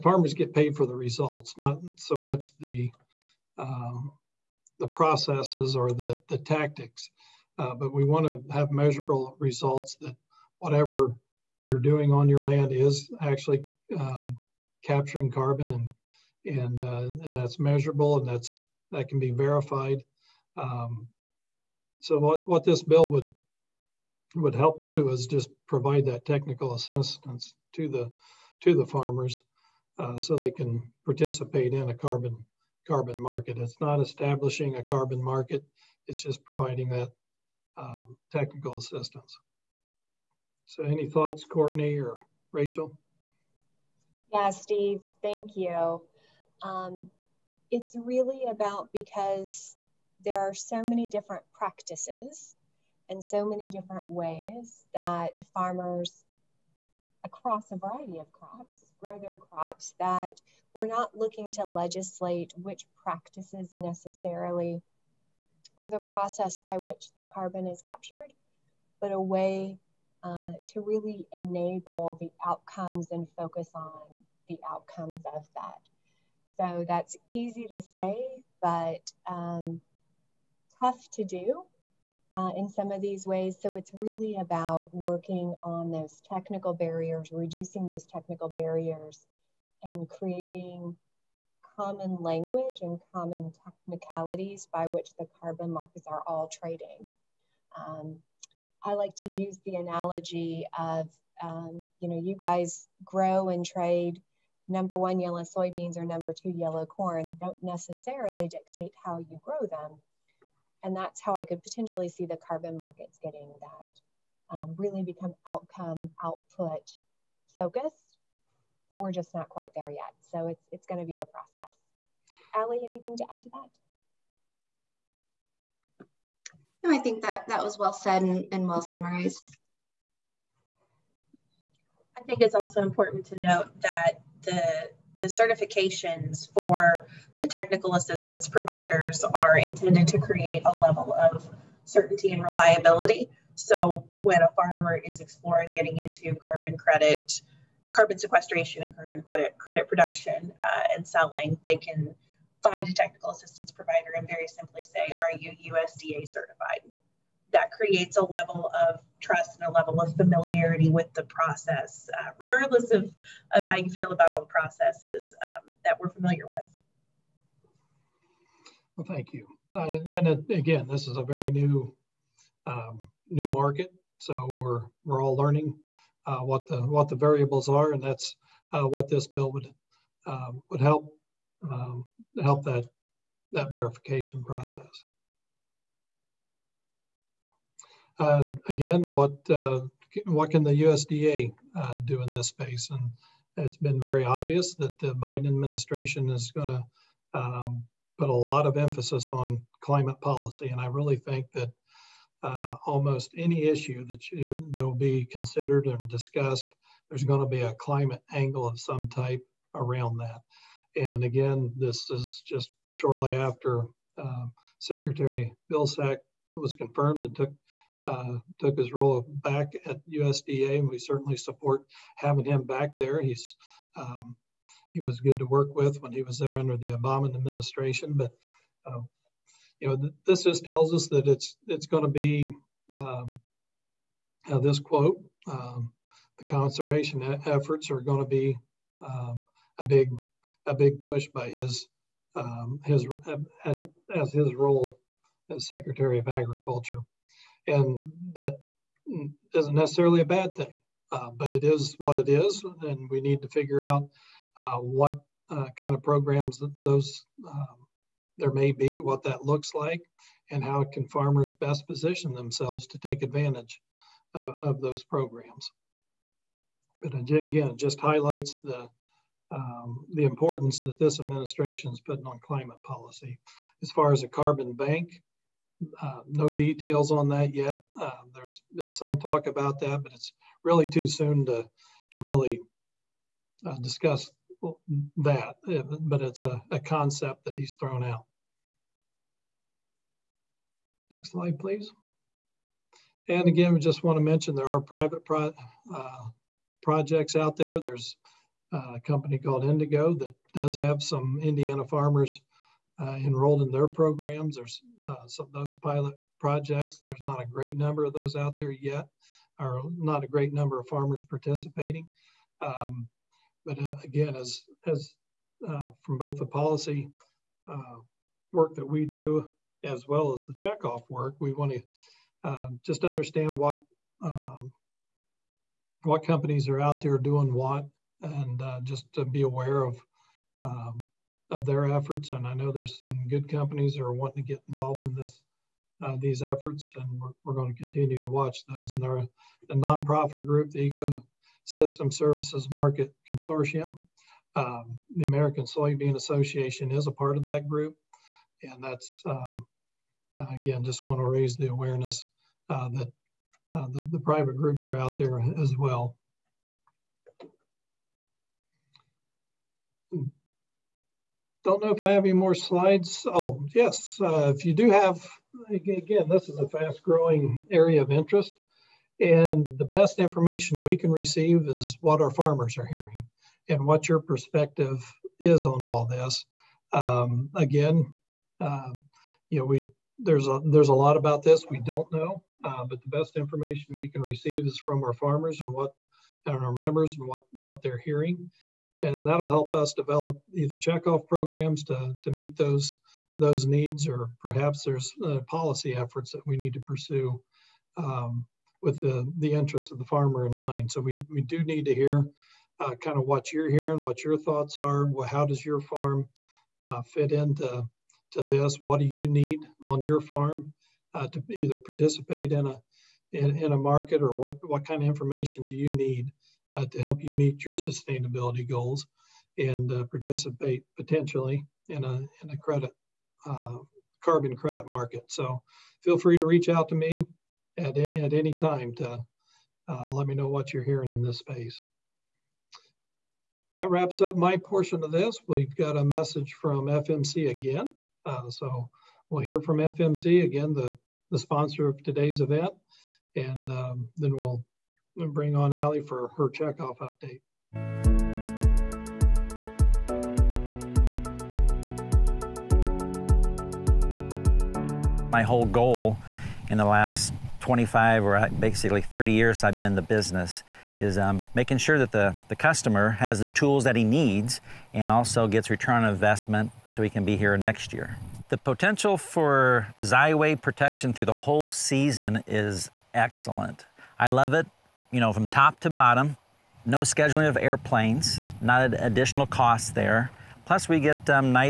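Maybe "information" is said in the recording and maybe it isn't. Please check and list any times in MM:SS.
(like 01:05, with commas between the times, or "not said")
06:10, 06:23, 06:55.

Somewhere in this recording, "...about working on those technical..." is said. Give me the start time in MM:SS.
01:24.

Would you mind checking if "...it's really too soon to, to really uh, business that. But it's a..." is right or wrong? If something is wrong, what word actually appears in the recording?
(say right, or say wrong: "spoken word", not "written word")
wrong: "discuss", not "business".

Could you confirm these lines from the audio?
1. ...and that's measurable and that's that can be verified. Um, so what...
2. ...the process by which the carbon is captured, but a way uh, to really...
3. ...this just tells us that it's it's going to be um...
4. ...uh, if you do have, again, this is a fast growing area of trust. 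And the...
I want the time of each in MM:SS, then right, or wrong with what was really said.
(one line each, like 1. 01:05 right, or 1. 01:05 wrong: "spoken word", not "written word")
1. 00:17 right
2. 01:05 right
3. 03:50 right
4. 06:04 wrong: "interest", not "trust".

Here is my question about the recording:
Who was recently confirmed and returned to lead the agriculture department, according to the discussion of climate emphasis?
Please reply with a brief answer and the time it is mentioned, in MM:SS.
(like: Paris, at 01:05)
Secretary Vilsack, at 03:34.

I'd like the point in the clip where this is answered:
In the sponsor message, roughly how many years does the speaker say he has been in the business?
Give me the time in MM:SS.
07:39.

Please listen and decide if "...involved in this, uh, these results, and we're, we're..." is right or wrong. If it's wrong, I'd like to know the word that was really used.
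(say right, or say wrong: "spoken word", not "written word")
wrong: "efforts", not "results".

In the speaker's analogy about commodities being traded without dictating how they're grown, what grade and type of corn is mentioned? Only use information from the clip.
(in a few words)
number two yellow corn.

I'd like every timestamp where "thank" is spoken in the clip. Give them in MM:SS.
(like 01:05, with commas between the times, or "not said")
00:45, 02:49.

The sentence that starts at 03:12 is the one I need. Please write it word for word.
And it's been very obvious that the Biden administration is going to um, put a lot of emphasis on climate policy.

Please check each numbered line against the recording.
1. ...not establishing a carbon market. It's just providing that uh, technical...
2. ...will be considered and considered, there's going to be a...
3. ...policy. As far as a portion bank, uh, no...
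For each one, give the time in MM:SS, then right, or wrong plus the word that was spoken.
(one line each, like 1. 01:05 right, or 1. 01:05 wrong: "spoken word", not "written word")
1. 00:33 right
2. 03:24 wrong: "discussed", not "considered"
3. 04:32 wrong: "carbon", not "portion".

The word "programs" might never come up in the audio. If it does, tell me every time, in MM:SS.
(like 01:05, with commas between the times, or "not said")
04:16, 04:25, 05:03, 06:31.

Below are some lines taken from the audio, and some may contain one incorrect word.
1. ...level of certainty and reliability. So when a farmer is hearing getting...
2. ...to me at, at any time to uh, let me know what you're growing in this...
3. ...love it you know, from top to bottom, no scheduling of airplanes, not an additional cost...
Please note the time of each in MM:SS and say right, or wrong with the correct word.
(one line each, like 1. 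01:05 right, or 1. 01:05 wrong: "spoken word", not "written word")
1. 02:20 wrong: "exploring", not "hearing"
2. 07:06 wrong: "hearing", not "growing"
3. 07:54 right.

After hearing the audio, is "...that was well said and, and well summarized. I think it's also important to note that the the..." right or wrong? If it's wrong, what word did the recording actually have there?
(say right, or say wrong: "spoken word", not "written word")
right.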